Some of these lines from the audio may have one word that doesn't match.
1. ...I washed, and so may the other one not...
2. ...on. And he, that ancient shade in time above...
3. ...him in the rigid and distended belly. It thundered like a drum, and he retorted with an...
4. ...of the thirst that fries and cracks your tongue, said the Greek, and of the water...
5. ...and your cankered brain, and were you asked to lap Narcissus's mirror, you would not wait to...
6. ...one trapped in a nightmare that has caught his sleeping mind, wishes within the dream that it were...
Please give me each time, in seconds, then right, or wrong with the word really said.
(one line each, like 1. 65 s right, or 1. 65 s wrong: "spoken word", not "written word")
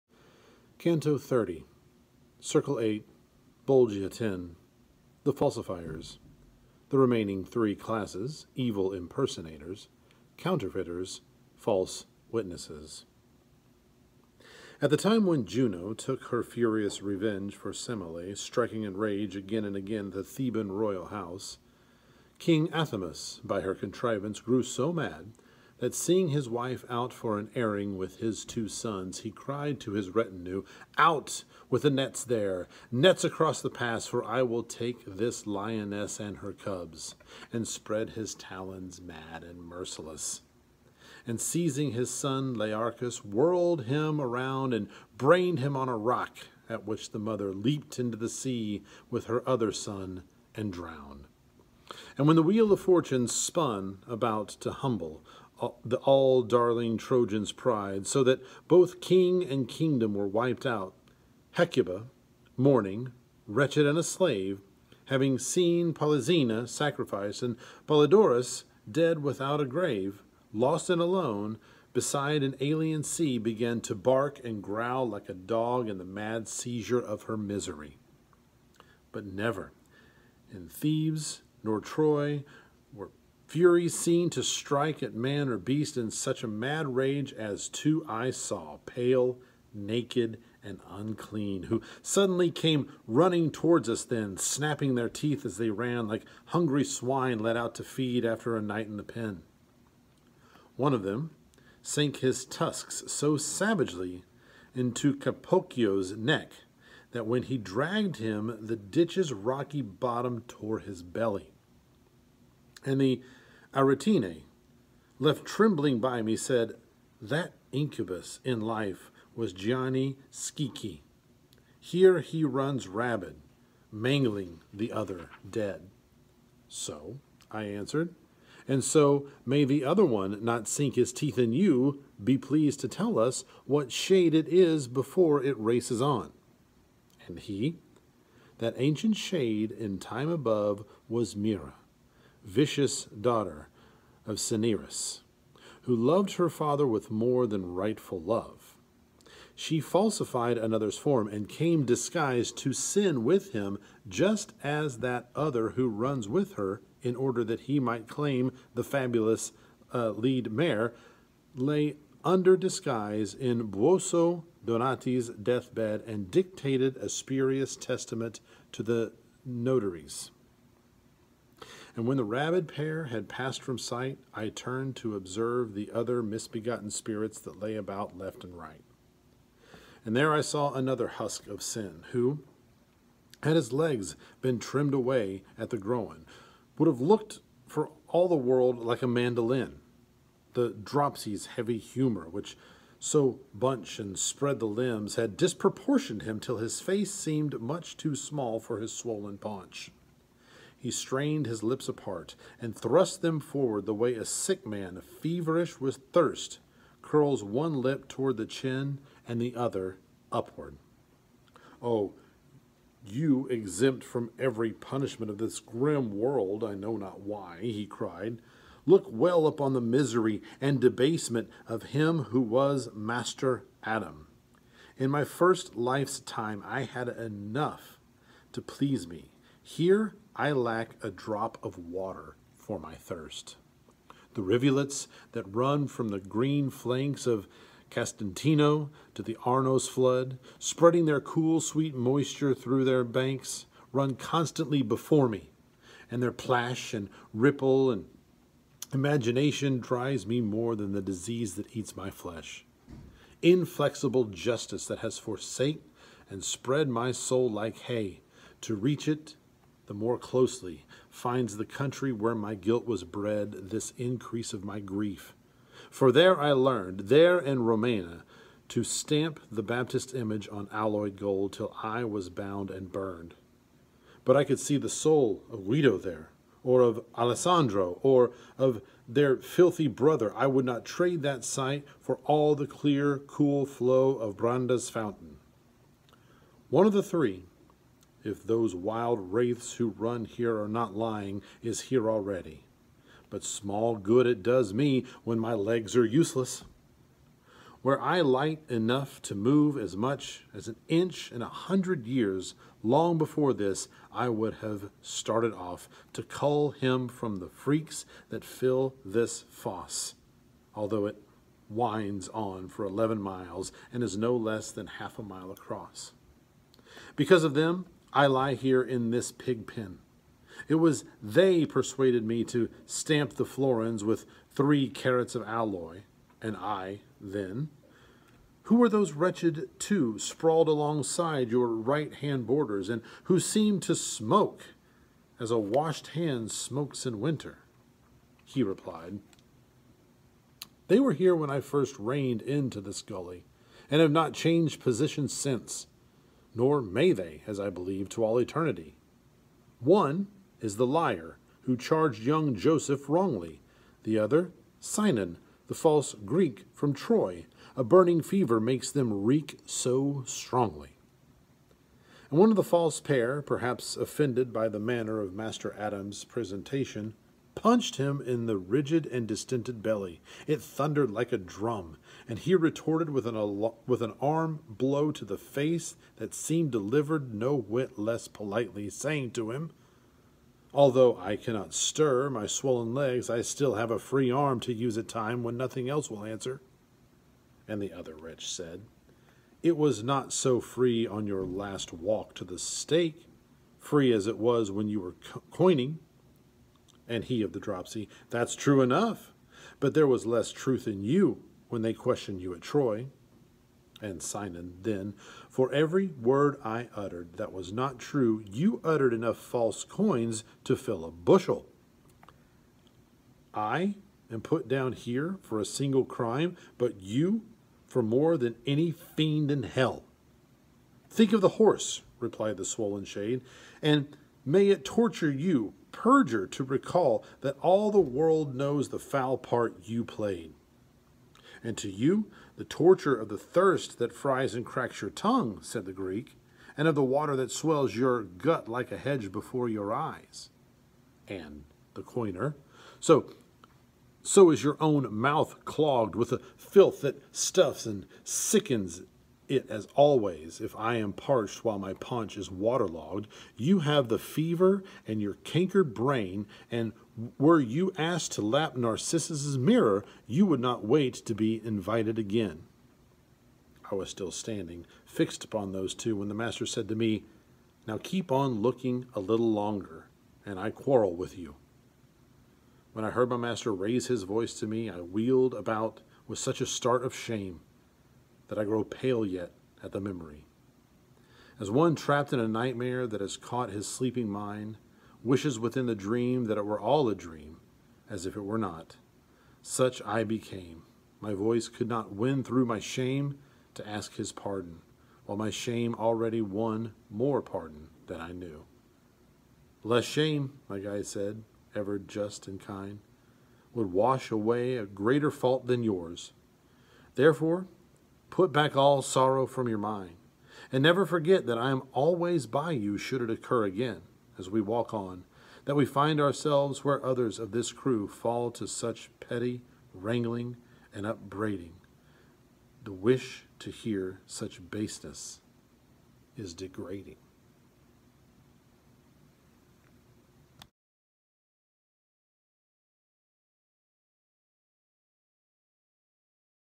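1. 127 s wrong: "answered", not "washed"
2. 136 s right
3. 367 s right
4. 433 s right
5. 455 s right
6. 481 s right.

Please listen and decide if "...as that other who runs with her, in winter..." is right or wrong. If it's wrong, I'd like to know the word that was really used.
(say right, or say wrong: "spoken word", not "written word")
wrong: "order", not "winter".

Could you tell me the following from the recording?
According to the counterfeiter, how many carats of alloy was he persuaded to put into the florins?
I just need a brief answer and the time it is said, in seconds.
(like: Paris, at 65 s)
3, at 324 s.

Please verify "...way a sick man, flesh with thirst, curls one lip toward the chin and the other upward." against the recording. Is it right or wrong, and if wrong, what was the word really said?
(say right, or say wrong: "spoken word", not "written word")
wrong: "feverish", not "flesh".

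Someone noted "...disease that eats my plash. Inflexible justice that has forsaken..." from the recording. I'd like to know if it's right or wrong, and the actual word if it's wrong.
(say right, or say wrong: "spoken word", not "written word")
wrong: "flesh", not "plash".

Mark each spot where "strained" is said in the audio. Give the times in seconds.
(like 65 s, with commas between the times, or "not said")
200 s.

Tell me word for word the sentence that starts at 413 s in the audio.
I am put down here for a single crime, but you for more than any fiend in hell.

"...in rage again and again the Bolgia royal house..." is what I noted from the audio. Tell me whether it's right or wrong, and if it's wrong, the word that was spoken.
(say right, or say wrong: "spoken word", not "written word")
wrong: "Theban", not "Bolgia".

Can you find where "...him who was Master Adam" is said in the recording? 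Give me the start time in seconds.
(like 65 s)
221 s.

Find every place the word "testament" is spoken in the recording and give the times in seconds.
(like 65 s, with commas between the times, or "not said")
167 s.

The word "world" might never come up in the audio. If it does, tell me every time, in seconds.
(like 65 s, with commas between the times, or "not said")
188 s, 216 s, 427 s.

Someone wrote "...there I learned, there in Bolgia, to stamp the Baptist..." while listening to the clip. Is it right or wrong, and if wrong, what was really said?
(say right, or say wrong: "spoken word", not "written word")
wrong: "Romena", not "Bolgia".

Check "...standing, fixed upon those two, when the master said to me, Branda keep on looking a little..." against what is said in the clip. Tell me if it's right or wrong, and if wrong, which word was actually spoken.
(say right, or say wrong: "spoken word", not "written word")
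wrong: "Now", not "Branda".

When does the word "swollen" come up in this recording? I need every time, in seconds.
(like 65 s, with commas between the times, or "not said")
198 s, 382 s, 422 s.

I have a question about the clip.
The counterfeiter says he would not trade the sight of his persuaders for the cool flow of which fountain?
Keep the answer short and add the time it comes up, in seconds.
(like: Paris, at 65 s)
Branda's fountain, at 284 s.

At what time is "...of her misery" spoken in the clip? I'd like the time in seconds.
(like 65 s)
77 s.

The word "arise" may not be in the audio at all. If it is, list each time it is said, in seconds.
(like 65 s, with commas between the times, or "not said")
not said.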